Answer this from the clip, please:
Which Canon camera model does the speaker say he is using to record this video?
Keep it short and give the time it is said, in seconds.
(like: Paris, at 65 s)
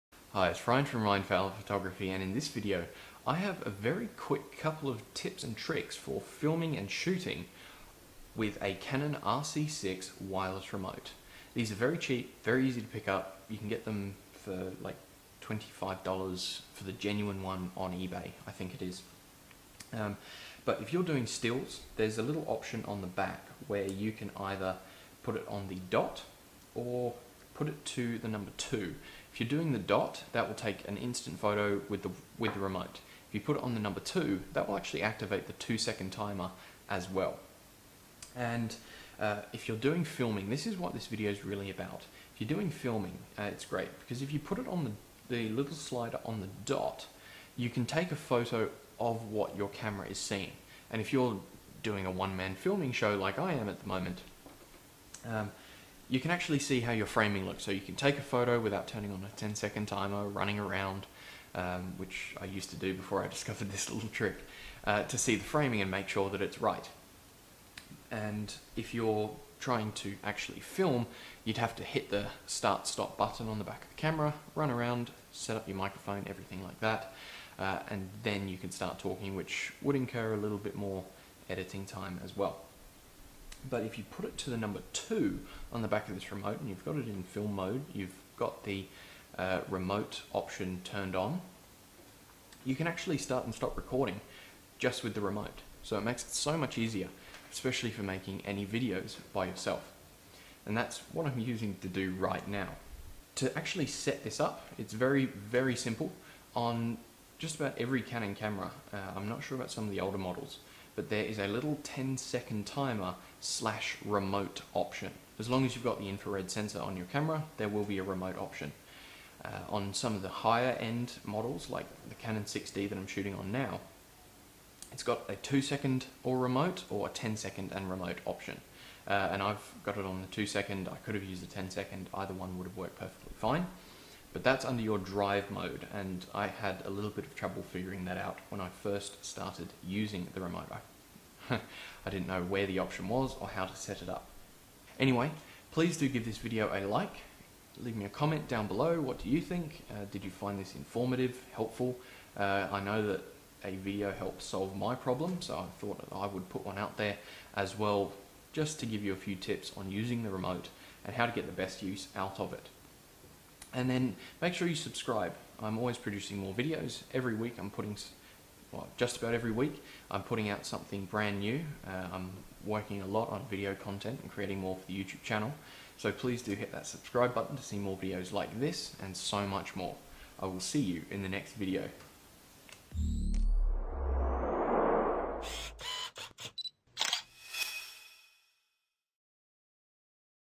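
Canon 6D, at 122 s.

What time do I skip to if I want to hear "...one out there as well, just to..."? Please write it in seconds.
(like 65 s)
156 s.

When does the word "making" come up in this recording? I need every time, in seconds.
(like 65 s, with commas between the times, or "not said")
98 s.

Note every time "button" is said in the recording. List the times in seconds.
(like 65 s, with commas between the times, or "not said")
73 s, 177 s.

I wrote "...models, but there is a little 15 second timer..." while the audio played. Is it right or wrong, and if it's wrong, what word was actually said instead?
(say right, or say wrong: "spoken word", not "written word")
wrong: "10", not "15".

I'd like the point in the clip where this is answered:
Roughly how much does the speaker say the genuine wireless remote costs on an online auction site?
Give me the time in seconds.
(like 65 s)
15 s.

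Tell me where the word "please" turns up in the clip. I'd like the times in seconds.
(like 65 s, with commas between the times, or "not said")
145 s, 176 s.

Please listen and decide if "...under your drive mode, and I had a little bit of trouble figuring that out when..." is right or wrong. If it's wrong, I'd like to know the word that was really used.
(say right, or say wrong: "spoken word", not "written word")
right.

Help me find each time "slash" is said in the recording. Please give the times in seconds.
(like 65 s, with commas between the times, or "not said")
113 s.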